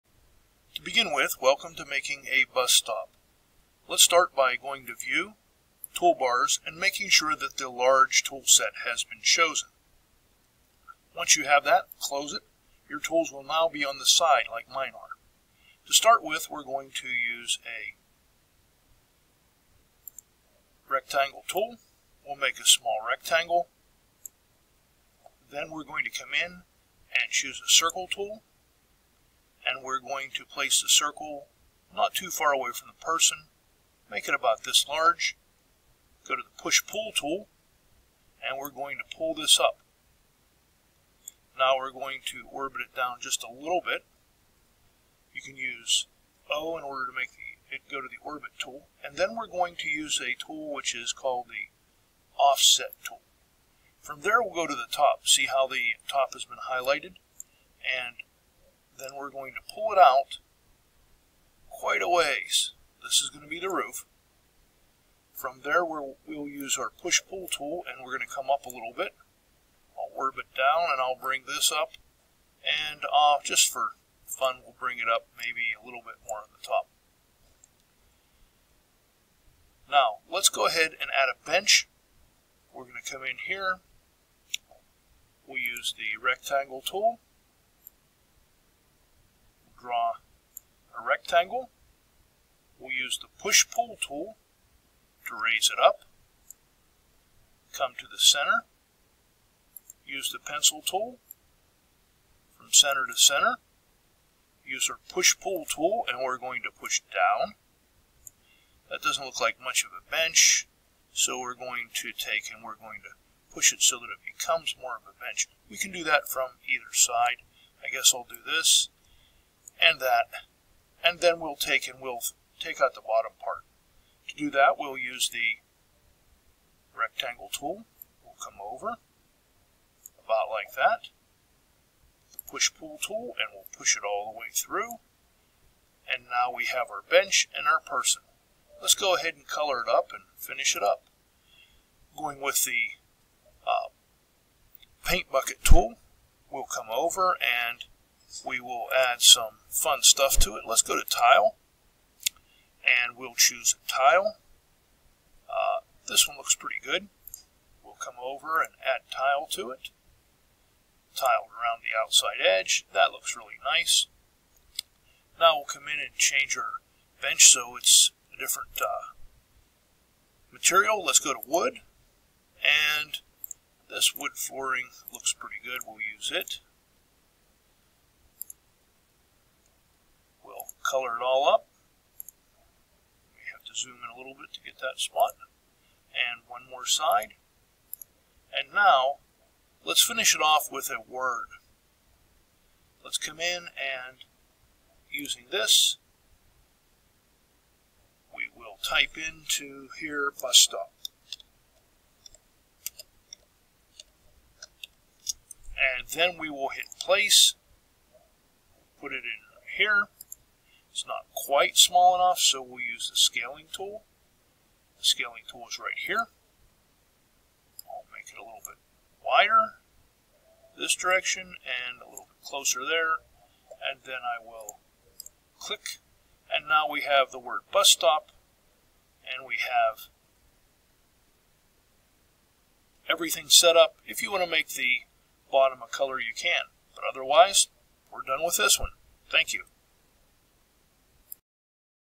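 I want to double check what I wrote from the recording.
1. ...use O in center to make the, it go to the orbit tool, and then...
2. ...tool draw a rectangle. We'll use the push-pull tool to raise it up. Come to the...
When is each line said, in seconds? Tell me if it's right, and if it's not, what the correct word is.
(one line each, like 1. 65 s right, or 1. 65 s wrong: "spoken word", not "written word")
1. 45 s wrong: "order", not "center"
2. 86 s right.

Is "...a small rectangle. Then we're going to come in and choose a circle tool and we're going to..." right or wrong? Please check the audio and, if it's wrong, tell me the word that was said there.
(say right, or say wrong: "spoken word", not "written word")
right.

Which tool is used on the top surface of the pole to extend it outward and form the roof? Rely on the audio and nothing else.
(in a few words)
offset tool.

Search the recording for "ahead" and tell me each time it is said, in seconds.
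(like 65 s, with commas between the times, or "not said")
80 s, 139 s.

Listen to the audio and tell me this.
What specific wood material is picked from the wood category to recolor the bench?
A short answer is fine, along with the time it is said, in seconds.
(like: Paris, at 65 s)
wood flooring, at 174 s.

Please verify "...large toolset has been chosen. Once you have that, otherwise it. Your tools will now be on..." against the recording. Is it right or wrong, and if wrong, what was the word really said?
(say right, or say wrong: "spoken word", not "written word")
wrong: "close", not "otherwise".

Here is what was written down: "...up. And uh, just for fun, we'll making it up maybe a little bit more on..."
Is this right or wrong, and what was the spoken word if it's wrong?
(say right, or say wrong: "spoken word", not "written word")
wrong: "bring", not "making".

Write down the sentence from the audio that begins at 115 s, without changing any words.
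We can do that from either side.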